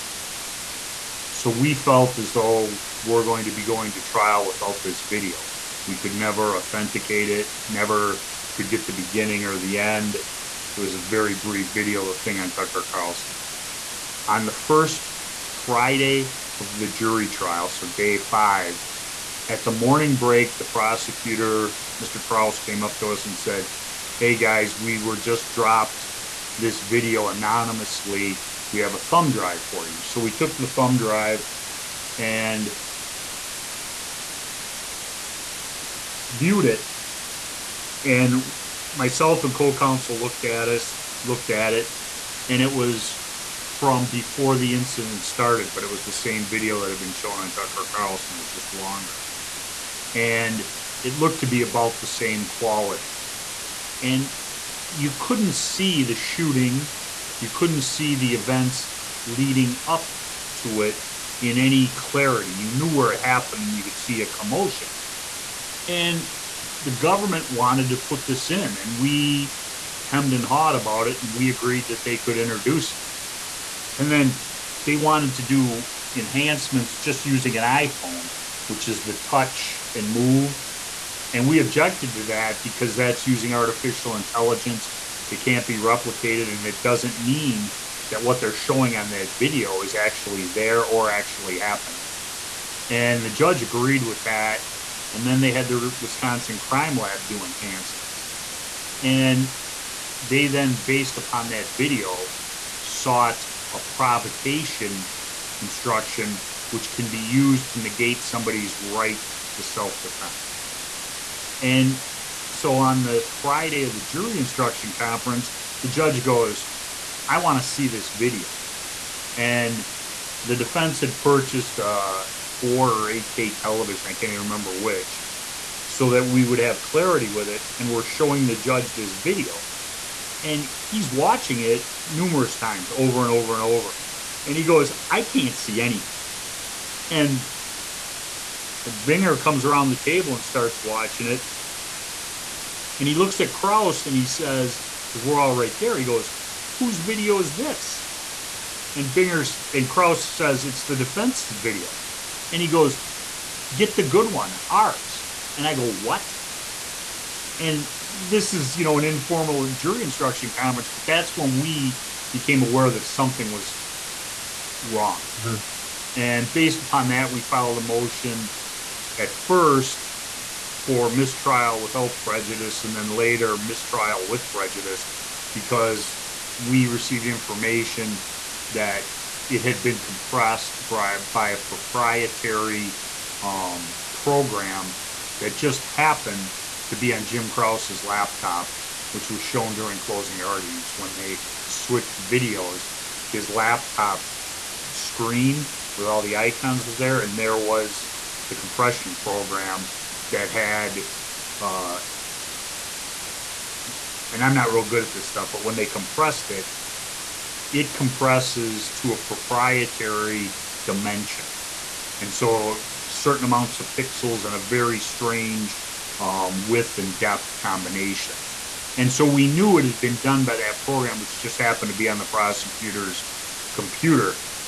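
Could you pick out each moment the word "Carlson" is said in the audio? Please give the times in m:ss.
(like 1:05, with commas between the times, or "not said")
0:12, 0:47.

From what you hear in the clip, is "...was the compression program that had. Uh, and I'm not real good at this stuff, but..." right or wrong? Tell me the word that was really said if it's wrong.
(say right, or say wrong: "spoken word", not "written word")
right.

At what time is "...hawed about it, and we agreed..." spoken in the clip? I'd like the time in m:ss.
1:10.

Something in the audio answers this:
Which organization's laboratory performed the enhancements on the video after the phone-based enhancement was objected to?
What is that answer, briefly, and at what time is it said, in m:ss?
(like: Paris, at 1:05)
Wisconsin Crime Lab, at 1:35.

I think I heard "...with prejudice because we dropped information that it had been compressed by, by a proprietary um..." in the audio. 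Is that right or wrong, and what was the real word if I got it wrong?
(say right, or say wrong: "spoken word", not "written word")
wrong: "received", not "dropped".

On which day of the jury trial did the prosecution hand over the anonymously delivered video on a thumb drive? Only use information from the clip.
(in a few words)
Day 5.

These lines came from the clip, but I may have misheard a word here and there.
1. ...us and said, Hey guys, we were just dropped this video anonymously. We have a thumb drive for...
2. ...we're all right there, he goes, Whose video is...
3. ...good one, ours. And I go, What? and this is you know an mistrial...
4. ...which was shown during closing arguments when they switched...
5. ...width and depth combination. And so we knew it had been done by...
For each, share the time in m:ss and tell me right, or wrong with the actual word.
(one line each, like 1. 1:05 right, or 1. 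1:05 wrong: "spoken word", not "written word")
1. 0:23 right
2. 2:25 right
3. 2:34 wrong: "informal", not "mistrial"
4. 3:09 right
5. 3:36 right.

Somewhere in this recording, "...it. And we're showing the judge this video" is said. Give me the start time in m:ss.
2:07.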